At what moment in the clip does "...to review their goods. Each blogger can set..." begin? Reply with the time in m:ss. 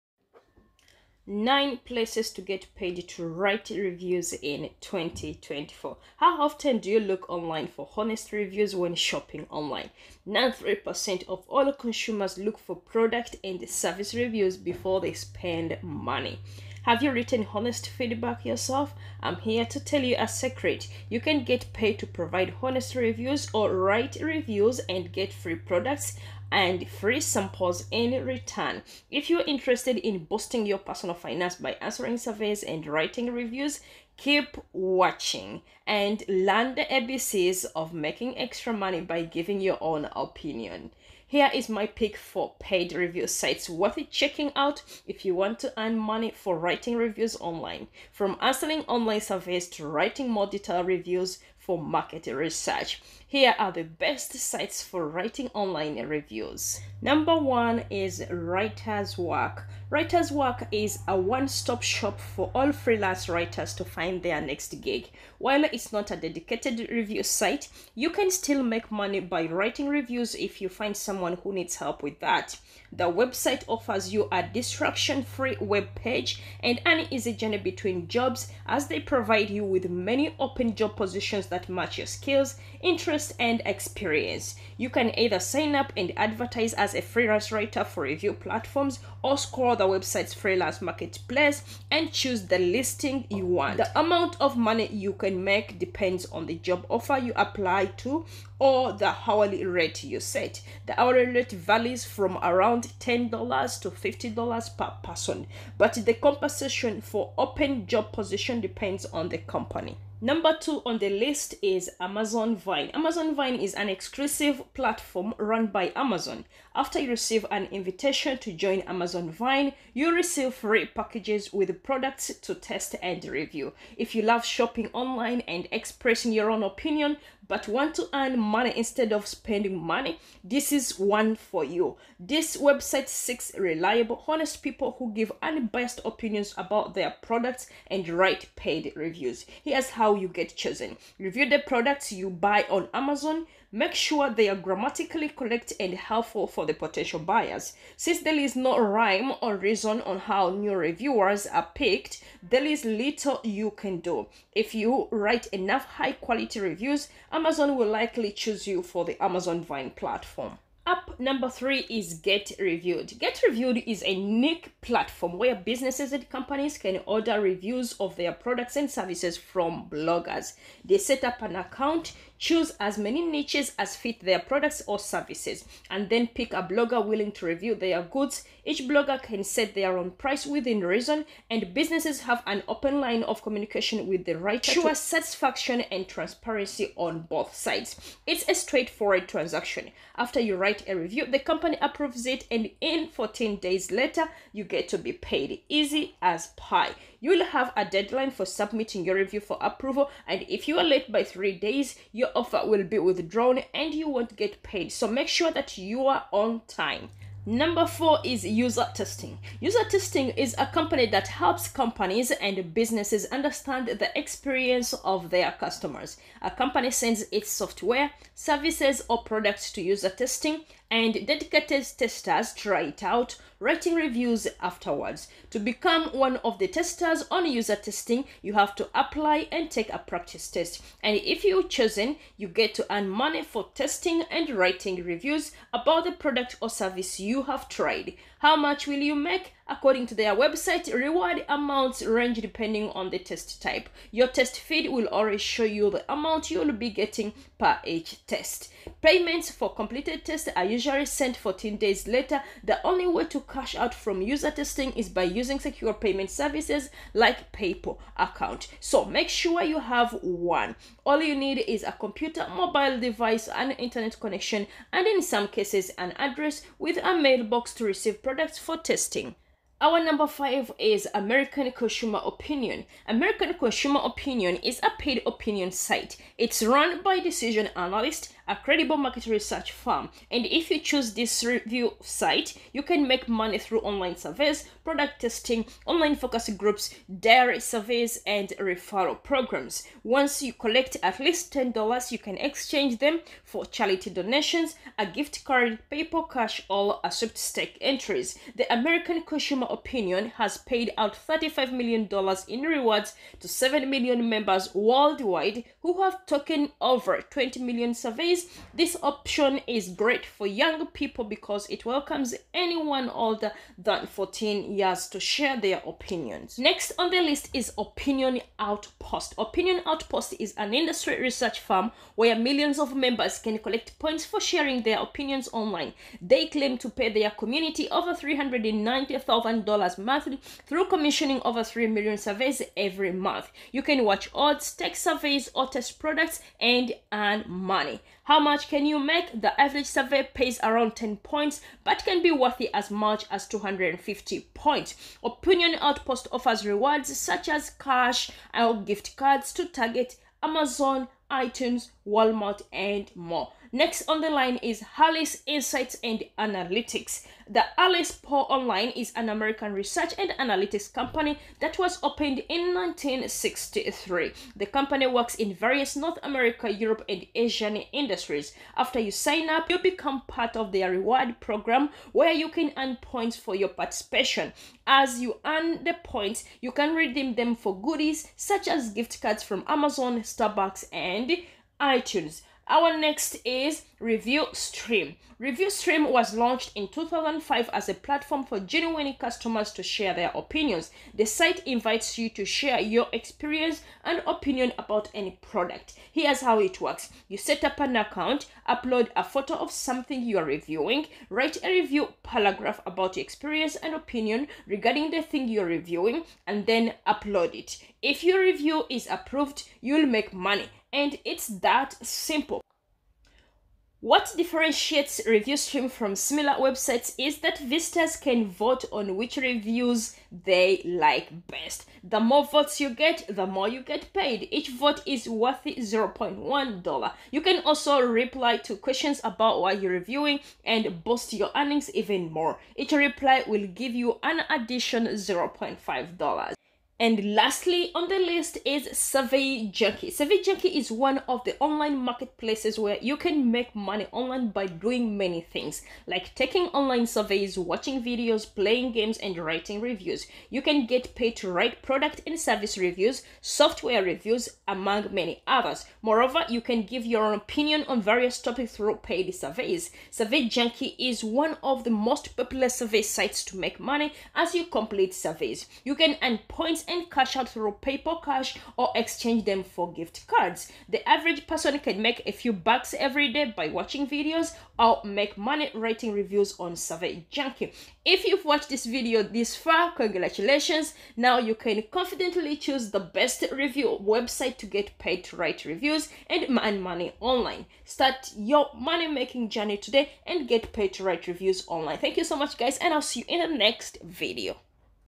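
2:57.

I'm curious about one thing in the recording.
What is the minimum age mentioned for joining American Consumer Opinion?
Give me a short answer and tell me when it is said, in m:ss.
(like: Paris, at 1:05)
14, at 5:14.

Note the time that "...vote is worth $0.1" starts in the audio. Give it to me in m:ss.
7:04.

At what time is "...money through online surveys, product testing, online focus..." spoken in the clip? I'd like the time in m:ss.
4:43.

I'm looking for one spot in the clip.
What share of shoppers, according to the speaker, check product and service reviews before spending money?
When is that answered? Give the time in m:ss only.
0:10.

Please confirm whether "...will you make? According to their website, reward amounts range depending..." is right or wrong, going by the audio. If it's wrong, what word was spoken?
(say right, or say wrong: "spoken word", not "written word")
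right.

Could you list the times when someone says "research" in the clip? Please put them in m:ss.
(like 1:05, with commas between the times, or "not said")
0:52, 4:39, 5:21, 5:59.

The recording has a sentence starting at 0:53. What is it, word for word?
Here are the best sites for writing online reviews.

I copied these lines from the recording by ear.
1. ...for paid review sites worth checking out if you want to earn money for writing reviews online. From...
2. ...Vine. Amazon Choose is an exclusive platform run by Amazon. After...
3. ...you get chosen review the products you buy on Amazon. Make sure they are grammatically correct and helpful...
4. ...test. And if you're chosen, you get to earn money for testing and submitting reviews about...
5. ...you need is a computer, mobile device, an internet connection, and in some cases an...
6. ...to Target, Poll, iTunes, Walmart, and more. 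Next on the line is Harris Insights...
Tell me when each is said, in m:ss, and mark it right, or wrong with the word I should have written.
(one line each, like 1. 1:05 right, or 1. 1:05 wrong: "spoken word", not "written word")
1. 0:42 right
2. 1:52 wrong: "Vine", not "Choose"
3. 2:20 right
4. 3:50 wrong: "writing", not "submitting"
5. 4:21 right
6. 5:49 wrong: "Amazon", not "Poll".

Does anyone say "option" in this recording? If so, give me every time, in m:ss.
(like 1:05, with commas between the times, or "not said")
5:09.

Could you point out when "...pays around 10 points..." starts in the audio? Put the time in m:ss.
5:40.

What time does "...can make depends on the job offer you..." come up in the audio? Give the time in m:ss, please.
1:35.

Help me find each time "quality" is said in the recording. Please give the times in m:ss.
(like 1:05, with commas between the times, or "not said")
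2:36.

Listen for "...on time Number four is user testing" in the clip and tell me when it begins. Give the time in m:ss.
3:26.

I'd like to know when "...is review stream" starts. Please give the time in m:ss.
6:23.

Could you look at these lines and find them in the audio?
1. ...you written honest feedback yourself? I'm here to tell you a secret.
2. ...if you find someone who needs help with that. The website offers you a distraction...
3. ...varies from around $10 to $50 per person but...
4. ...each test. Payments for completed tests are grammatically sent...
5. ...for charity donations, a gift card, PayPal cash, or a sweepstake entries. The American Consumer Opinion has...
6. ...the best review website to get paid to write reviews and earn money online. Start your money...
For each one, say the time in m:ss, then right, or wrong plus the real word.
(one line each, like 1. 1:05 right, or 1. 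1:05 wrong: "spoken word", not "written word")
1. 0:17 right
2. 1:10 right
3. 1:41 right
4. 4:07 wrong: "usually", not "grammatically"
5. 4:53 right
6. 8:02 right.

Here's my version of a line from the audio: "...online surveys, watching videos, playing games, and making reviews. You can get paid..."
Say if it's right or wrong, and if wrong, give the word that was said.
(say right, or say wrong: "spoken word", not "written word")
wrong: "writing", not "making".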